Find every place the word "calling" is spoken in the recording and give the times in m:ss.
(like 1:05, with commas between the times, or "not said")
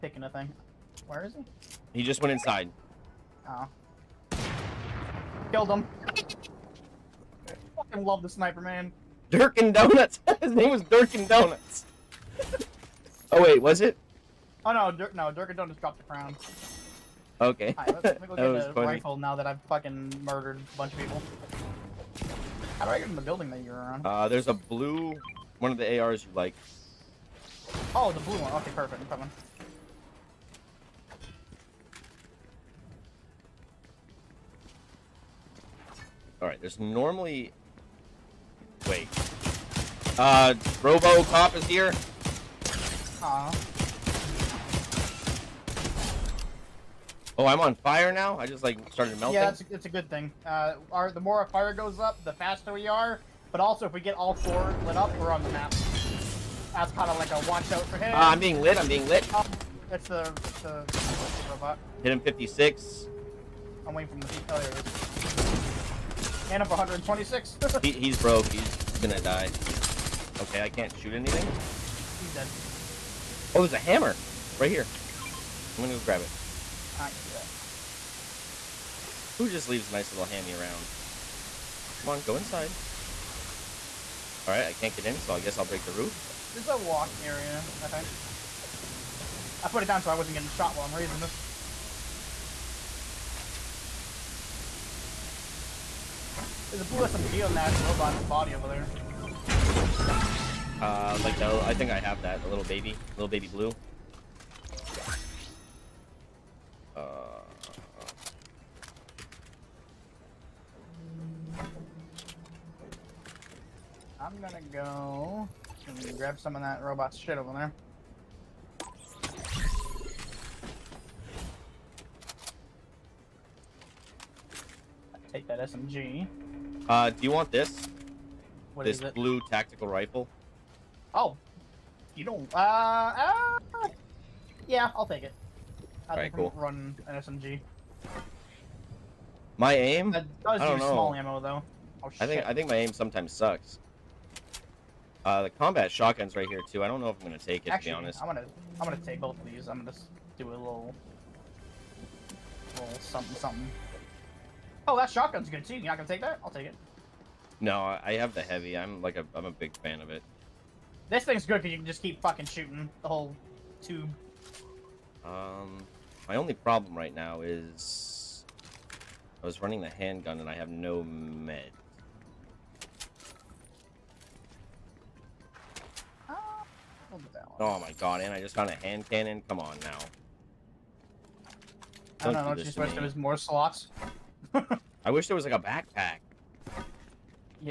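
not said.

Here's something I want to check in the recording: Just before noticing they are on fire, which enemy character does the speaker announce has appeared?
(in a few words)
Robo Cop.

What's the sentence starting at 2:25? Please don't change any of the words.
Uh, the combat shotgun's right here too.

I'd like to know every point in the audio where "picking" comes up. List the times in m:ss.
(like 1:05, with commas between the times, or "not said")
0:00.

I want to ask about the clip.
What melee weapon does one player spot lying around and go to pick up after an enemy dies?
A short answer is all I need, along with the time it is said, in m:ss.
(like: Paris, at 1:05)
A hammer, at 1:13.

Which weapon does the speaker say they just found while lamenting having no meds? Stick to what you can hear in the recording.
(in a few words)
Hand cannon.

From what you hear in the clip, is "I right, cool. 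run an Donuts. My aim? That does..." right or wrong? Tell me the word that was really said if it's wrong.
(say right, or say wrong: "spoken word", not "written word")
wrong: "SMG", not "Donuts".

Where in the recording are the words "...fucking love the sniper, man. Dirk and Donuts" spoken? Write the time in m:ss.
0:07.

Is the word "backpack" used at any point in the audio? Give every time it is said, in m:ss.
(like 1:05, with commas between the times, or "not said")
3:05.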